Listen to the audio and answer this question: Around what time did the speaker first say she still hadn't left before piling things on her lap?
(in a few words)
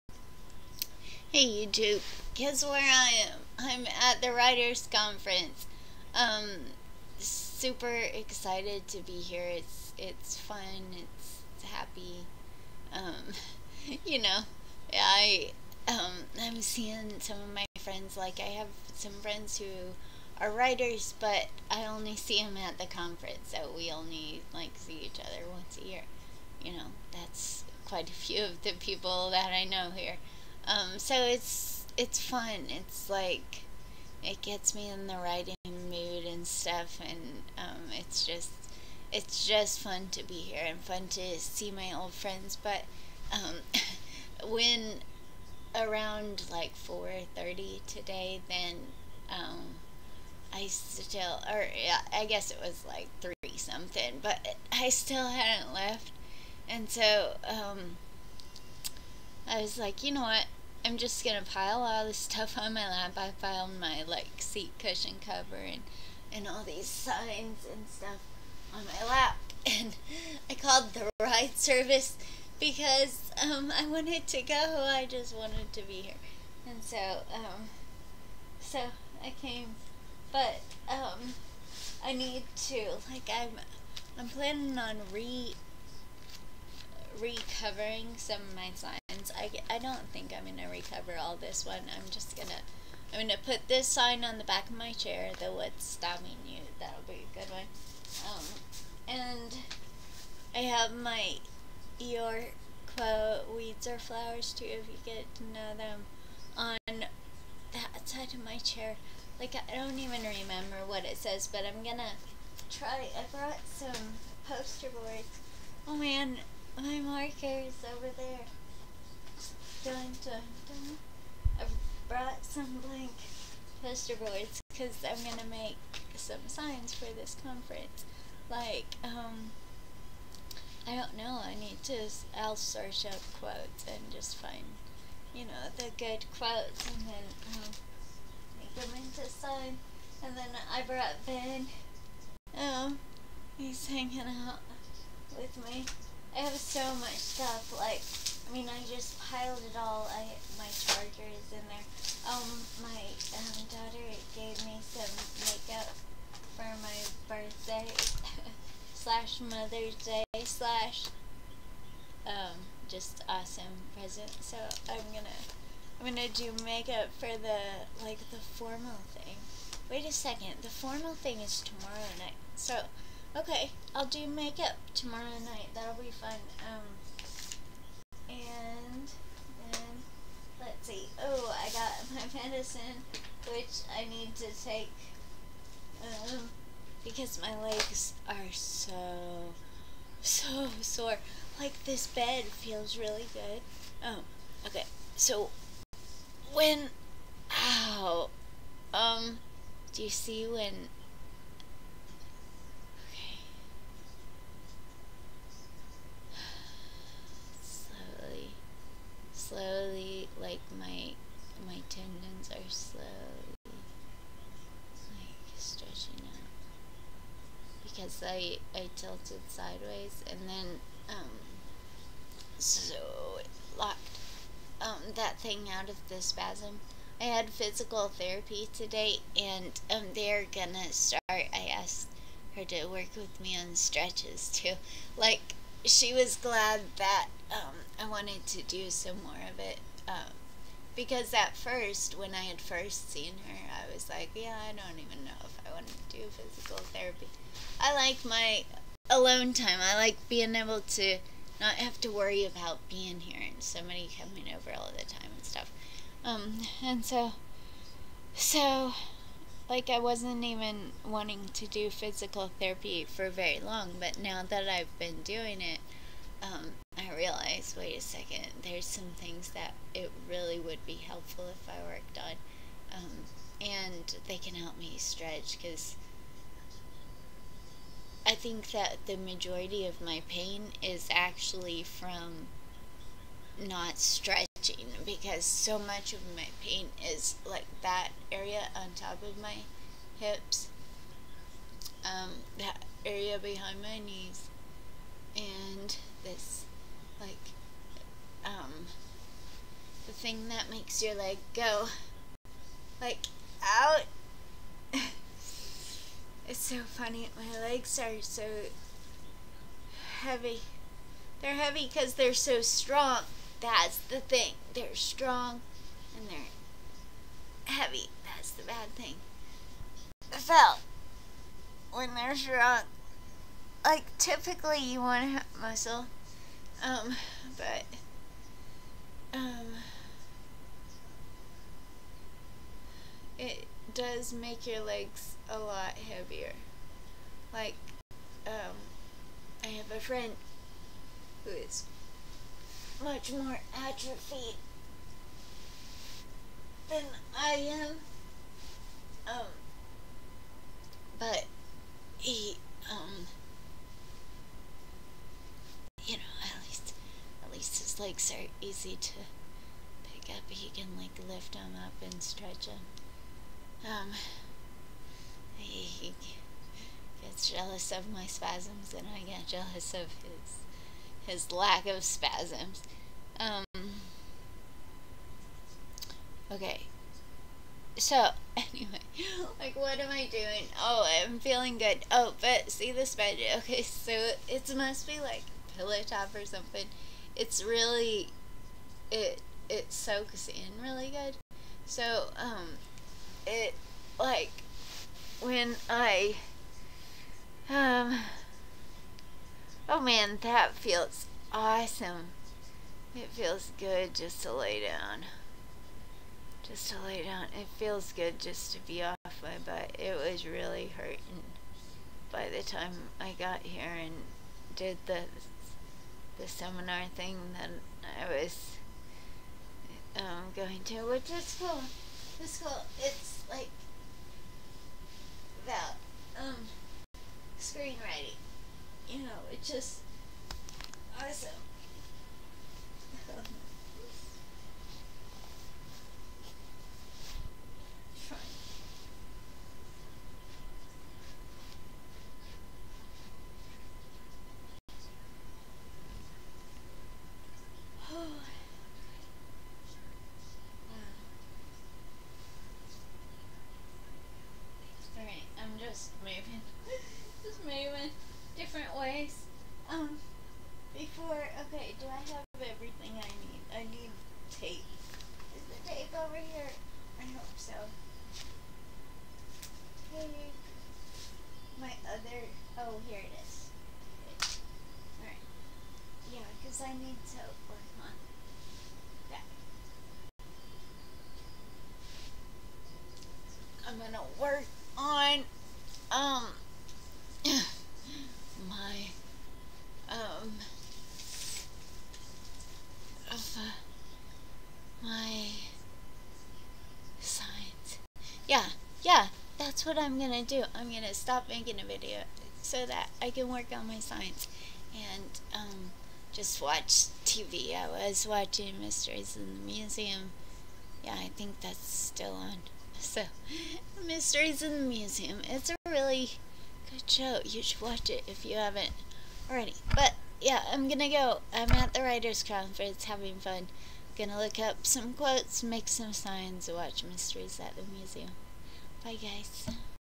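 4:30.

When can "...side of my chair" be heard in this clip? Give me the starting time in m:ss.
1:48.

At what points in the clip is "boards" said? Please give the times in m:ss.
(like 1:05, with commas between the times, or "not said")
1:54, 2:04.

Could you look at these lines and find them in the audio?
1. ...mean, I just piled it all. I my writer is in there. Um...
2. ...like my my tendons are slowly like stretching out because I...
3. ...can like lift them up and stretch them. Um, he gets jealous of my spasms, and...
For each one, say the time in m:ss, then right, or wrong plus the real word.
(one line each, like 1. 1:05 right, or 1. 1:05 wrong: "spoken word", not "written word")
1. 2:28 wrong: "charger", not "writer"
2. 3:30 right
3. 6:00 right.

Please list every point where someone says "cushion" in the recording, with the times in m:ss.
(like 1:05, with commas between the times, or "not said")
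1:04.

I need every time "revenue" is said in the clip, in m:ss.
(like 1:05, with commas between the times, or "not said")
not said.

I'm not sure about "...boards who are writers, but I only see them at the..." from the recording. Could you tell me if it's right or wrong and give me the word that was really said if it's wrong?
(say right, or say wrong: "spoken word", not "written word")
wrong: "friends", not "boards".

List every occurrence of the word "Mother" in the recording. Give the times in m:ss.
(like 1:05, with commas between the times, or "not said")
2:39.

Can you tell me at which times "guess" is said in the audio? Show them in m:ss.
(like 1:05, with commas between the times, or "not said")
0:02, 0:52.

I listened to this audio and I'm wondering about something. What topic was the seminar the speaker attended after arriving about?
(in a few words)
screenwriting.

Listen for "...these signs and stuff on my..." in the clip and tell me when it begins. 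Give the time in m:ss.
1:06.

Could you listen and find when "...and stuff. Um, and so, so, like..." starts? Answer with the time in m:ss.
4:15.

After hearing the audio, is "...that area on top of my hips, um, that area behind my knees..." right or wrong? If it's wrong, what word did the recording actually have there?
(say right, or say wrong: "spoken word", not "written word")
right.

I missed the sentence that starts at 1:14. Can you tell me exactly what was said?
I just wanted to be here, and so um, so I came.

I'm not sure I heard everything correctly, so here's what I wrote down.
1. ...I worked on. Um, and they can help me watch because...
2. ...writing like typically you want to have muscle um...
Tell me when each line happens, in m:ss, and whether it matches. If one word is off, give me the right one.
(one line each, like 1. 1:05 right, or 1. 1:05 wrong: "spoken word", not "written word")
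1. 4:31 wrong: "stretch", not "watch"
2. 5:22 wrong: "strong", not "writing".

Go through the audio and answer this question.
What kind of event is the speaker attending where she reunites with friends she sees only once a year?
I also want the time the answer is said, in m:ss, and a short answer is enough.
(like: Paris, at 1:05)
writers conference, at 0:04.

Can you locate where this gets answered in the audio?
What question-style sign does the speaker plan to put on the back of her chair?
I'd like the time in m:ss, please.
1:35.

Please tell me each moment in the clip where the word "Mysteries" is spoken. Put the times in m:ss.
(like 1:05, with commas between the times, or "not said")
8:28, 8:34, 8:47.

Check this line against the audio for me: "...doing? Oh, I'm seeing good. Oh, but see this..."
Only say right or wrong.
wrong.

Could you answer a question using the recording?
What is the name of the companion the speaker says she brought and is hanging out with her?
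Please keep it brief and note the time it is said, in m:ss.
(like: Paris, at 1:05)
Ben, at 2:21.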